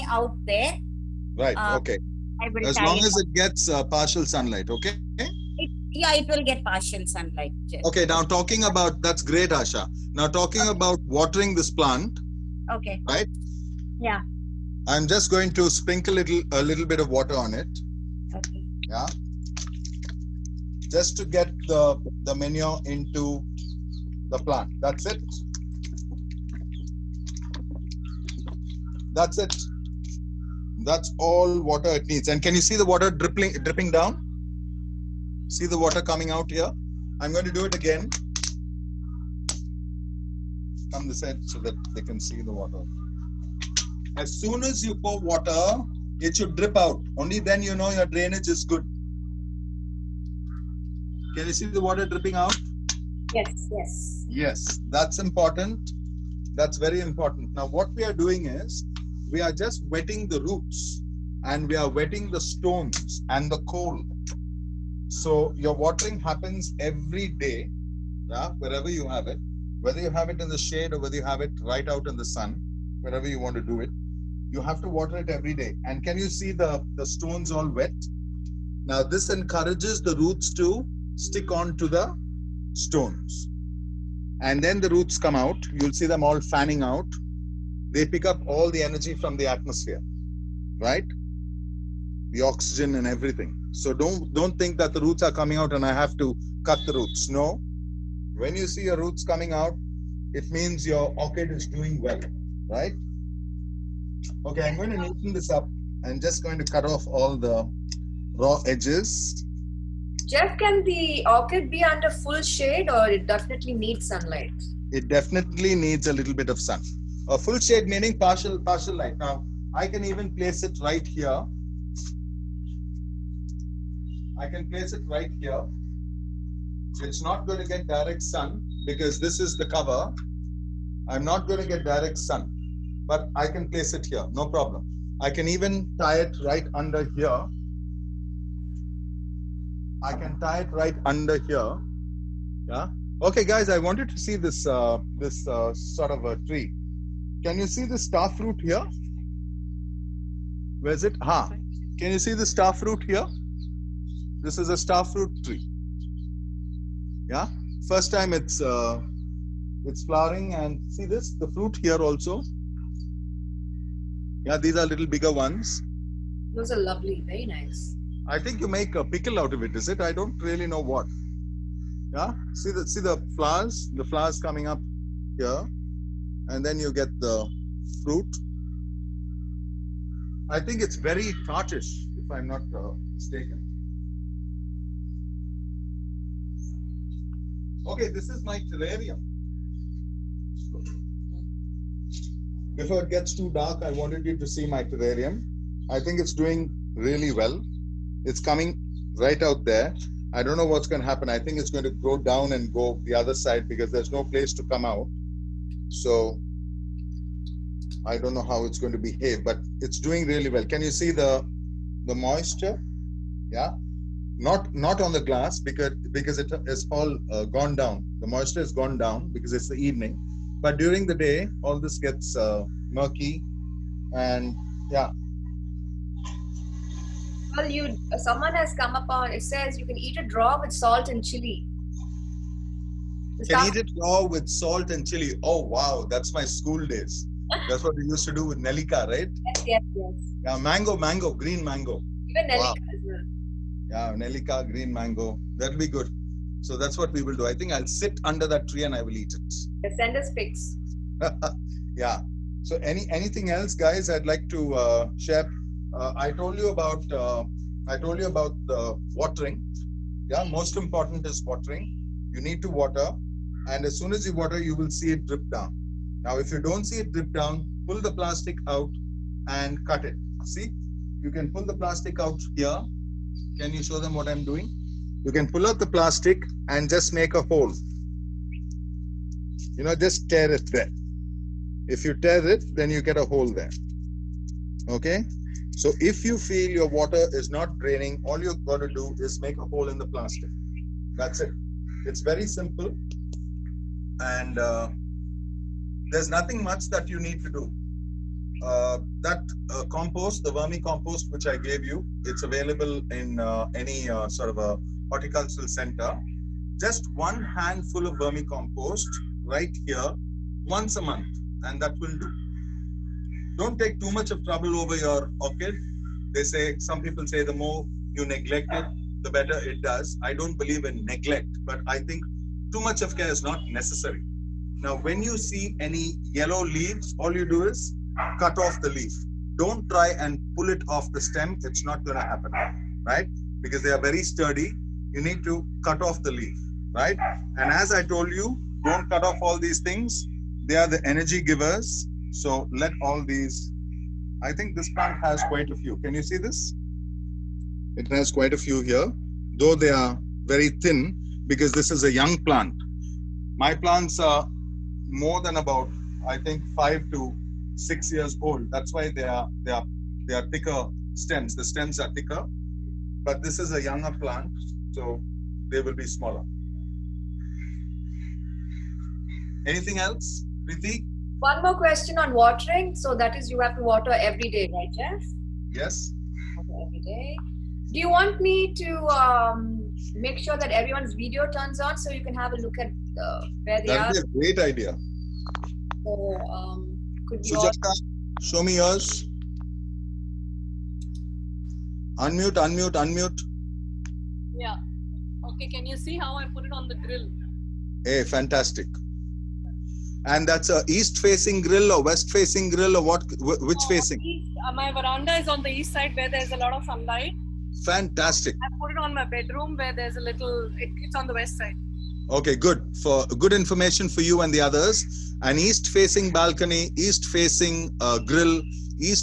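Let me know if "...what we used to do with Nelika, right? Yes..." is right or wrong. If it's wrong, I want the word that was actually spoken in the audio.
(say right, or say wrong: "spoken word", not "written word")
right.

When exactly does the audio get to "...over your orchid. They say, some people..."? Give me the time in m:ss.
5:14.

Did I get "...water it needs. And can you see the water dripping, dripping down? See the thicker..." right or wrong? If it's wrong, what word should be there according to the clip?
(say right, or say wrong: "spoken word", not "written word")
wrong: "water", not "thicker".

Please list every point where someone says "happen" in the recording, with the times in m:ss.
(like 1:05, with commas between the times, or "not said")
1:06, 3:21, 5:32.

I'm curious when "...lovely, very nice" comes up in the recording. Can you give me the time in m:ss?
2:46.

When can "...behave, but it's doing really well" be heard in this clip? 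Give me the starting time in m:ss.
3:28.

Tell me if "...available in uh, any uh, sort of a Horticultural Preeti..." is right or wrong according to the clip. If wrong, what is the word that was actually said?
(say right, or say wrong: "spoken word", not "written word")
wrong: "Center", not "Preeti".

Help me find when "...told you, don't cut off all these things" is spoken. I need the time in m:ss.
5:38.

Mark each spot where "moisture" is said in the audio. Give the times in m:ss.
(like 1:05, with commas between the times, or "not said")
3:32, 3:38.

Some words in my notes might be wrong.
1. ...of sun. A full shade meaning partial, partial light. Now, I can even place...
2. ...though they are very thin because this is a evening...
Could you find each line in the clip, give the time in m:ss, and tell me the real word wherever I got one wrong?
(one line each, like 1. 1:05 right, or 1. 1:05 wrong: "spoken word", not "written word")
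1. 1:56 right
2. 5:49 wrong: "young", not "evening".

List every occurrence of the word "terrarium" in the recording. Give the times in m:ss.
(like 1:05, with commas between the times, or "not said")
3:08, 3:14.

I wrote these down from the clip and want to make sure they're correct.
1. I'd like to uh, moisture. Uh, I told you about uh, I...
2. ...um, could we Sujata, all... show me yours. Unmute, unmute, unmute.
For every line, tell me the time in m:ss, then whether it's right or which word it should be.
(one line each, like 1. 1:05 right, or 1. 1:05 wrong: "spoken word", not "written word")
1. 4:14 wrong: "share", not "moisture"
2. 6:26 right.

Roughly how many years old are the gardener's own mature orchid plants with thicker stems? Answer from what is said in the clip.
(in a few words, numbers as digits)
5 to 6 years.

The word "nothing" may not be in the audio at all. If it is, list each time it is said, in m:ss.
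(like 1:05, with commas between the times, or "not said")
4:56.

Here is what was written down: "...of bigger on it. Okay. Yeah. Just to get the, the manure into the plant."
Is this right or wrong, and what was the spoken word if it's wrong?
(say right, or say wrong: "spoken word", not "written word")
wrong: "water", not "bigger".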